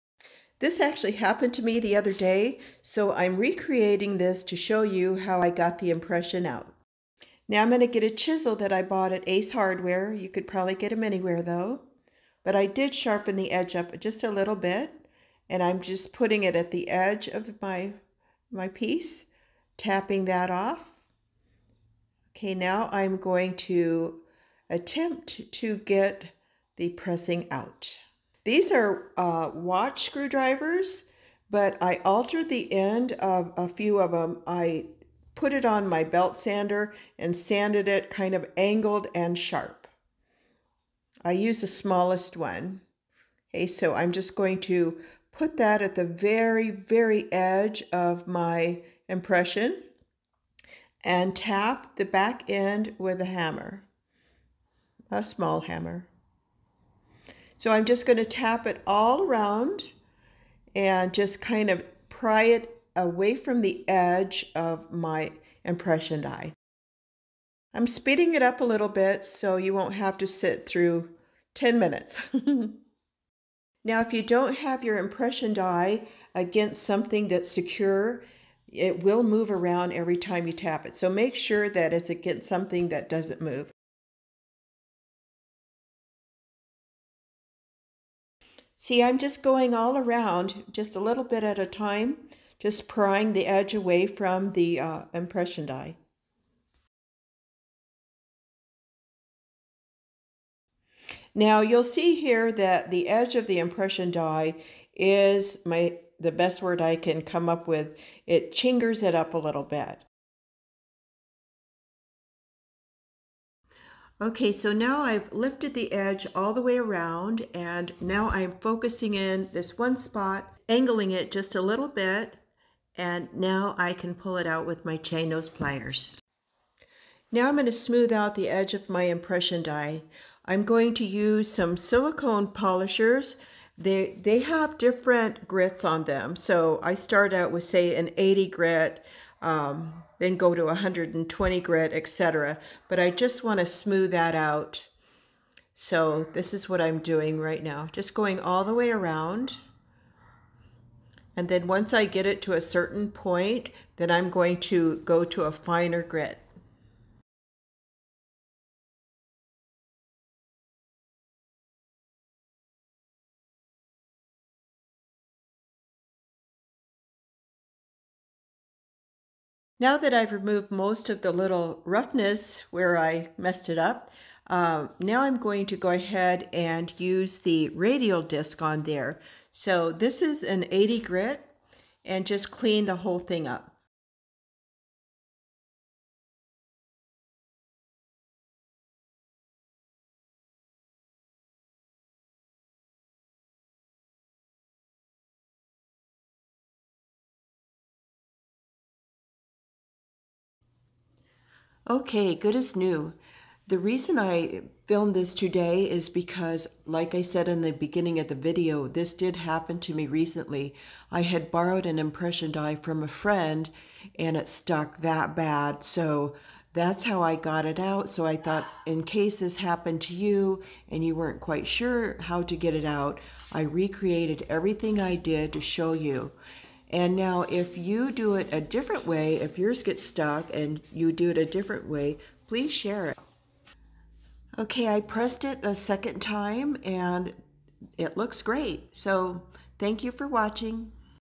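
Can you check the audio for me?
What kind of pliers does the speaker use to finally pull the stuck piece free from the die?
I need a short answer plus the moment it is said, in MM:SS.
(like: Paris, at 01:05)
chain nose pliers, at 02:04.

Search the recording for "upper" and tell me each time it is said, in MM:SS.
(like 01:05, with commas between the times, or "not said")
not said.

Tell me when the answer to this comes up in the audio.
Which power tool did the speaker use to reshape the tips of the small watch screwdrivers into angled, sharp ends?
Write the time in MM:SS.
00:36.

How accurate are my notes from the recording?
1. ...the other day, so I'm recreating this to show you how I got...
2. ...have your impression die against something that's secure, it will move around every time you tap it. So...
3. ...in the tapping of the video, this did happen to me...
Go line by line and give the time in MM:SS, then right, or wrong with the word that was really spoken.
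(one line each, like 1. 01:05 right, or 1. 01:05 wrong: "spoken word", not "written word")
1. 00:01 right
2. 01:14 right
3. 03:27 wrong: "beginning", not "tapping".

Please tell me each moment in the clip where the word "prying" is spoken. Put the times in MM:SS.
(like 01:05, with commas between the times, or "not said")
01:32.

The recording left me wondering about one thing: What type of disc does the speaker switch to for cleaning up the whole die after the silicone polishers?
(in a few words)
radial disc.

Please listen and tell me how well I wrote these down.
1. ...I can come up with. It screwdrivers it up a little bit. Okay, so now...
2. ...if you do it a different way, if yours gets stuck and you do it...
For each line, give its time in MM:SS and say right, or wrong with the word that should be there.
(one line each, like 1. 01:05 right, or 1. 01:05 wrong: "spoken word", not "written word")
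1. 01:46 wrong: "chingers", not "screwdrivers"
2. 03:47 right.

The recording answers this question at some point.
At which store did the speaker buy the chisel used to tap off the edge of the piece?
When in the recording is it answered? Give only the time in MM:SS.
00:09.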